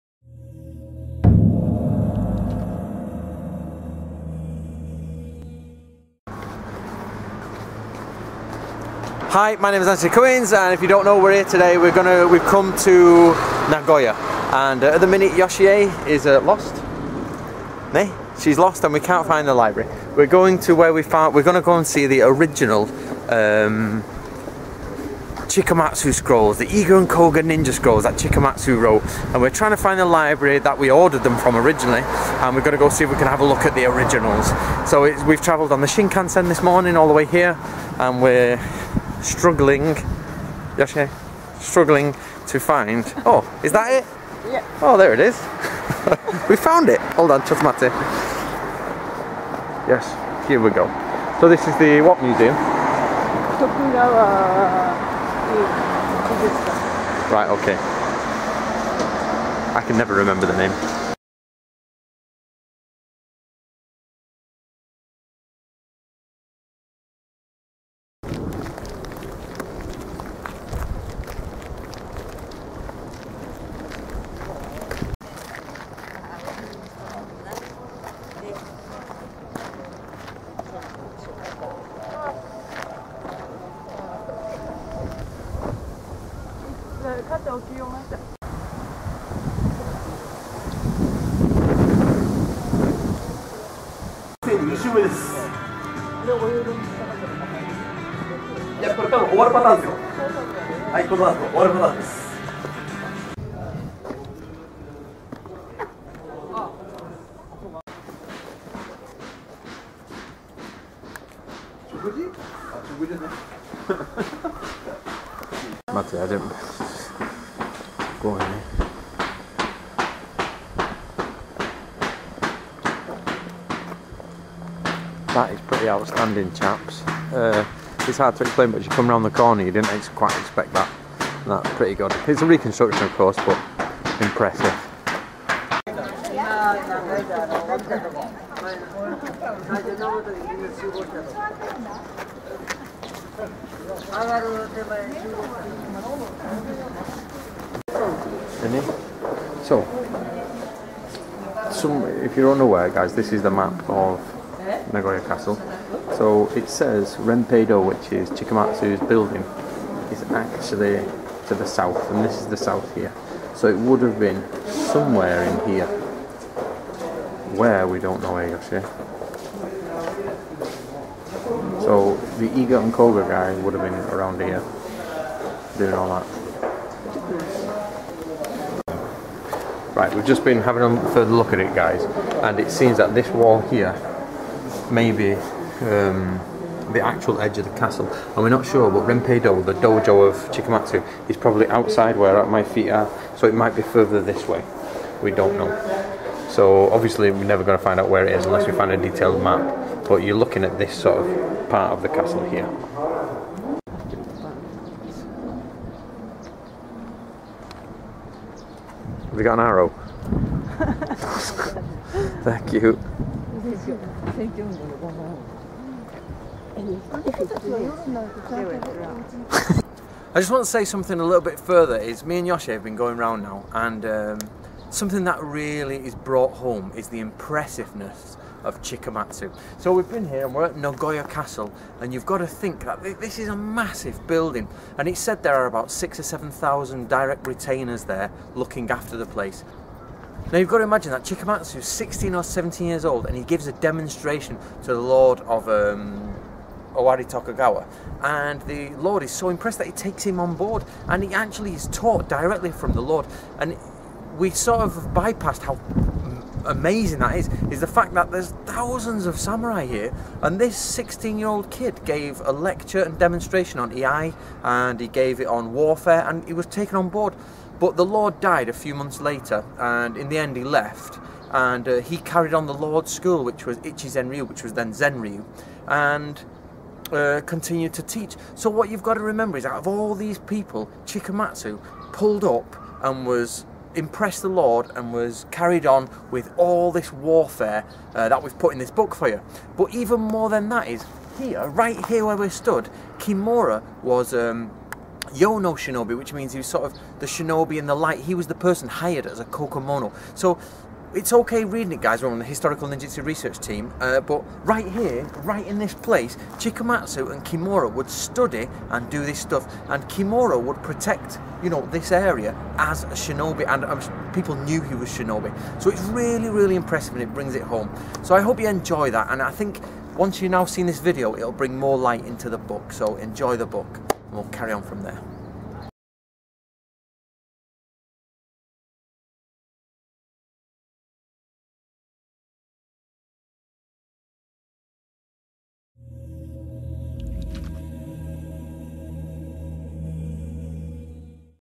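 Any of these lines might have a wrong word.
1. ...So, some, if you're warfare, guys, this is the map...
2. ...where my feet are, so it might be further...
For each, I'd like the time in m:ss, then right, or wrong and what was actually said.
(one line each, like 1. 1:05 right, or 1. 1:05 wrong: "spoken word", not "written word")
1. 2:29 wrong: "unaware", not "warfare"
2. 3:12 right.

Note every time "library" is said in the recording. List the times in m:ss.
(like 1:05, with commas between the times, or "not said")
0:19, 0:30.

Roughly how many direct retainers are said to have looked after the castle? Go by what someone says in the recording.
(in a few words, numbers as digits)
6,000 or 7,000.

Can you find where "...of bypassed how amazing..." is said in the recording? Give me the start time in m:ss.
4:14.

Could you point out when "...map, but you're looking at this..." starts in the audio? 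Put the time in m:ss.
3:19.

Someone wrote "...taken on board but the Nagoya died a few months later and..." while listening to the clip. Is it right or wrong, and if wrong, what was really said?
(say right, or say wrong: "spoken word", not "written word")
wrong: "Lord", not "Nagoya".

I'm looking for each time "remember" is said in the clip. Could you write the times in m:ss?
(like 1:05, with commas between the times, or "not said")
1:00, 4:39.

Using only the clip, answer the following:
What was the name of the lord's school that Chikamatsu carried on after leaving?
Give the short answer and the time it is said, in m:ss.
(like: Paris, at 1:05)
Ichi Zenryu, at 4:33.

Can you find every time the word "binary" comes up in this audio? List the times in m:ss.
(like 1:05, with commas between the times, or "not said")
not said.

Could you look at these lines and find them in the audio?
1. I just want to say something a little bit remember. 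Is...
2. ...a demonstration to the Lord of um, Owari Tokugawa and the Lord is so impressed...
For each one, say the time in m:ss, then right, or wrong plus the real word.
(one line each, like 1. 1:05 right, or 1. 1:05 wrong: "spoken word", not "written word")
1. 3:40 wrong: "further", not "remember"
2. 4:03 right.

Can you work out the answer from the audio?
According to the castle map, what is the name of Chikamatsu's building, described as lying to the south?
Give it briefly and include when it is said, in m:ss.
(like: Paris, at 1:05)
Renpeido, at 2:37.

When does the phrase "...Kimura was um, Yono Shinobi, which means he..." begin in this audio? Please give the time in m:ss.
4:53.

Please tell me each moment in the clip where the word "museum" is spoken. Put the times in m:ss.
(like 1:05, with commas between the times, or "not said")
0:52.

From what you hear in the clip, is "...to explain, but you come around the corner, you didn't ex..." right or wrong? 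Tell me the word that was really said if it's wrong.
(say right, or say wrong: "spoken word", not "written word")
right.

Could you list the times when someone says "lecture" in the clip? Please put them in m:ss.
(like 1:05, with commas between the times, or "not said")
4:22.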